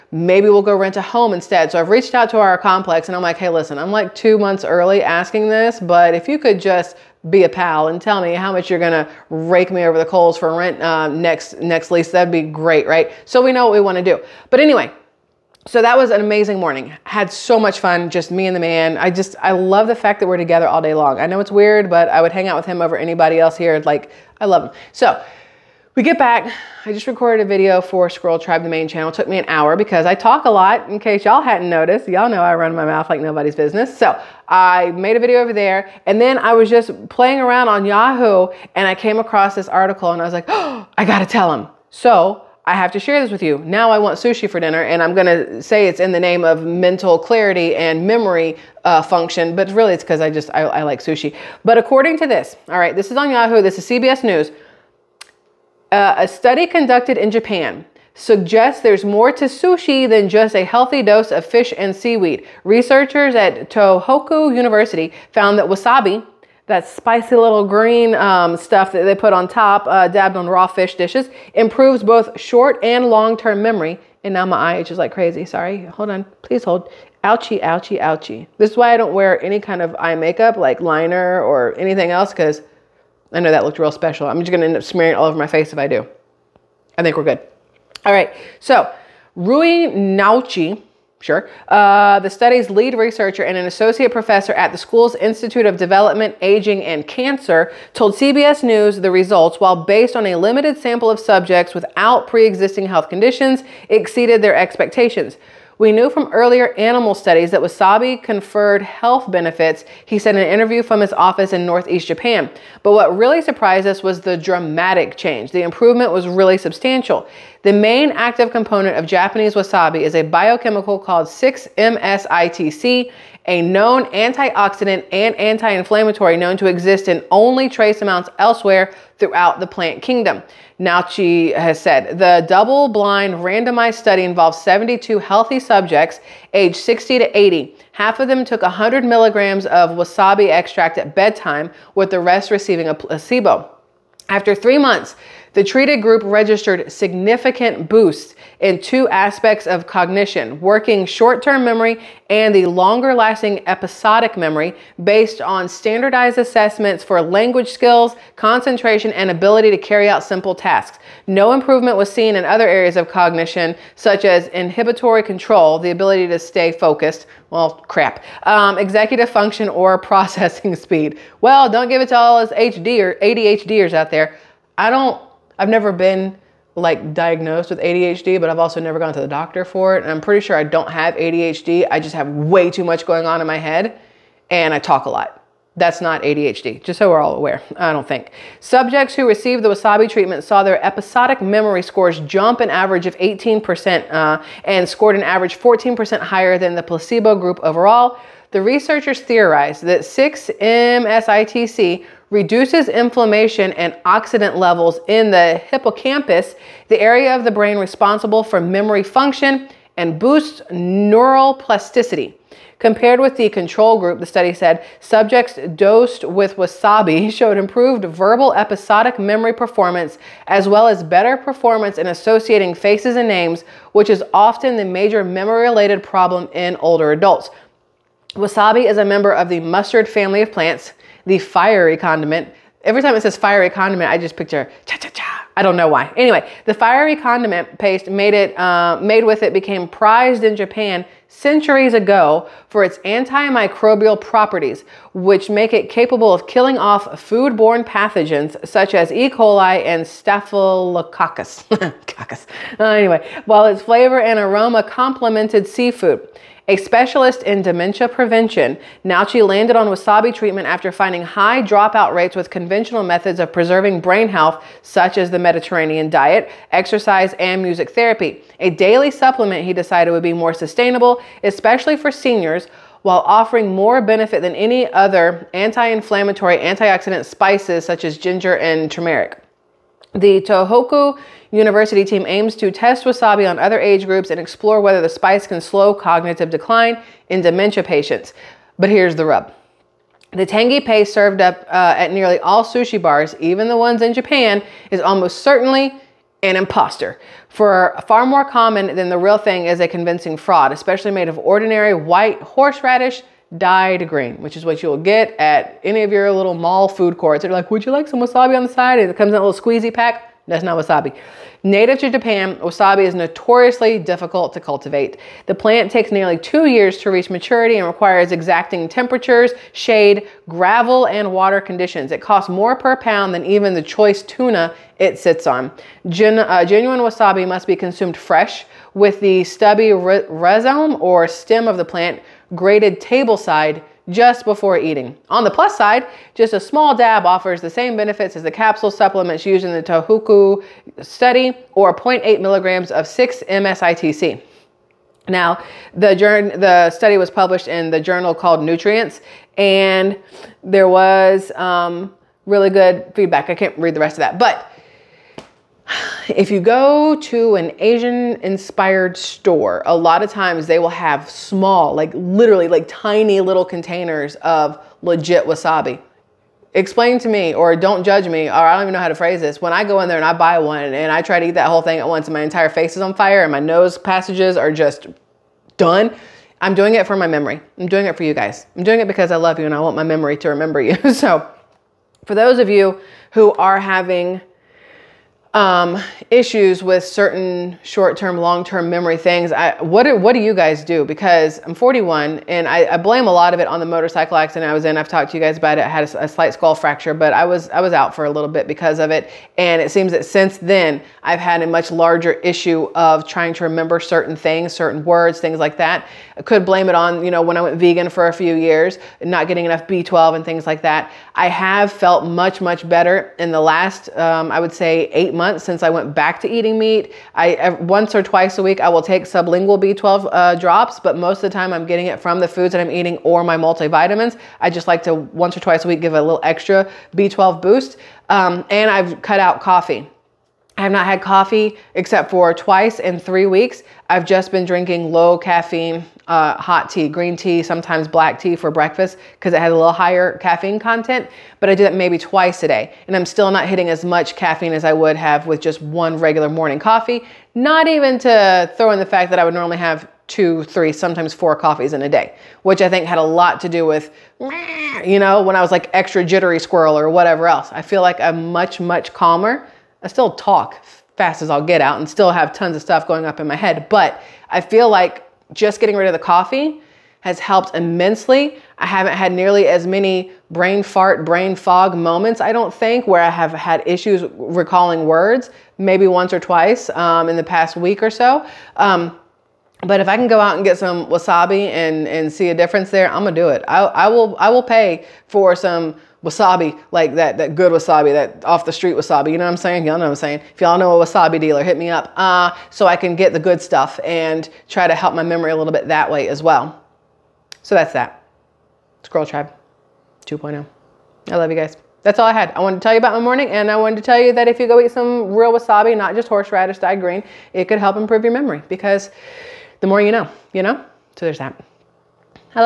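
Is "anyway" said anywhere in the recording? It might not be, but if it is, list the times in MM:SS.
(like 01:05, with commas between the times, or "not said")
00:14, 03:56, 04:12.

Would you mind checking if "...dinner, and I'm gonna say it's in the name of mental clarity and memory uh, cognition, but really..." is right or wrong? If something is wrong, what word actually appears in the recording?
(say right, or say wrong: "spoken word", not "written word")
wrong: "function", not "cognition".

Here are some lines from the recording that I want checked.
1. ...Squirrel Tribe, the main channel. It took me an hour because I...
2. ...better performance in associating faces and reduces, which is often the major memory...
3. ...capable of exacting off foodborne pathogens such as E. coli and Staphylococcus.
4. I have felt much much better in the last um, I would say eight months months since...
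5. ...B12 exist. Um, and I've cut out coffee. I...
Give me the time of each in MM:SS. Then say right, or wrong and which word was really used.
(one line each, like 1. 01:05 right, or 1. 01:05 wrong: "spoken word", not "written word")
1. 00:28 right
2. 03:41 wrong: "names", not "reduces"
3. 04:05 wrong: "killing", not "exacting"
4. 06:51 right
5. 07:07 wrong: "boost", not "exist".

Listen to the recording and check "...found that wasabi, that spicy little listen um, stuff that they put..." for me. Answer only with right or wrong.
wrong.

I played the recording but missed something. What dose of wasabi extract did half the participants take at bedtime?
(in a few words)
100 milligrams.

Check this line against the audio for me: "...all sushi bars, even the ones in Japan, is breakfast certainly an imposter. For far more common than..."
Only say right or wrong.
wrong.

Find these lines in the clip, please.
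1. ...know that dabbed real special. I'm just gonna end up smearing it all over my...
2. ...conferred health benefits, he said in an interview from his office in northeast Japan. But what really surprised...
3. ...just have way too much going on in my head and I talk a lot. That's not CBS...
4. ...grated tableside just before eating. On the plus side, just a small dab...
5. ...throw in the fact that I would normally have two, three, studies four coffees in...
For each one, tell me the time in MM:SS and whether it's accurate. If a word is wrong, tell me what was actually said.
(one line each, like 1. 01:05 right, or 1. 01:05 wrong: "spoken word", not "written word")
1. 01:23 wrong: "looked", not "dabbed"
2. 01:48 right
3. 03:02 wrong: "ADHD", not "CBS"
4. 05:32 right
5. 07:28 wrong: "sometimes", not "studies".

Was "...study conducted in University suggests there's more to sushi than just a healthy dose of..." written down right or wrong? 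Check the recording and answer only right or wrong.
wrong.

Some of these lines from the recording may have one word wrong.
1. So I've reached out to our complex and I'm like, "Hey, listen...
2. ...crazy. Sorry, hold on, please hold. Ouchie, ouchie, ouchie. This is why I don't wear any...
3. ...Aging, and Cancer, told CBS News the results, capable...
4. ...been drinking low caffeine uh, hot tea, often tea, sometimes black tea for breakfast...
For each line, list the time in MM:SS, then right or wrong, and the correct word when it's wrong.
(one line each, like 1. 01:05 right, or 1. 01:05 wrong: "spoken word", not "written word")
1. 00:01 right
2. 01:15 right
3. 01:36 wrong: "while", not "capable"
4. 07:14 wrong: "green", not "often".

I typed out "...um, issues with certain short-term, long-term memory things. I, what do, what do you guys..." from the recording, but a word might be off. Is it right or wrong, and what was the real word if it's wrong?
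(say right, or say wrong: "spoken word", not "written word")
right.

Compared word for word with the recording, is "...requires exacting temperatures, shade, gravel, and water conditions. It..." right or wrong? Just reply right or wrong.
right.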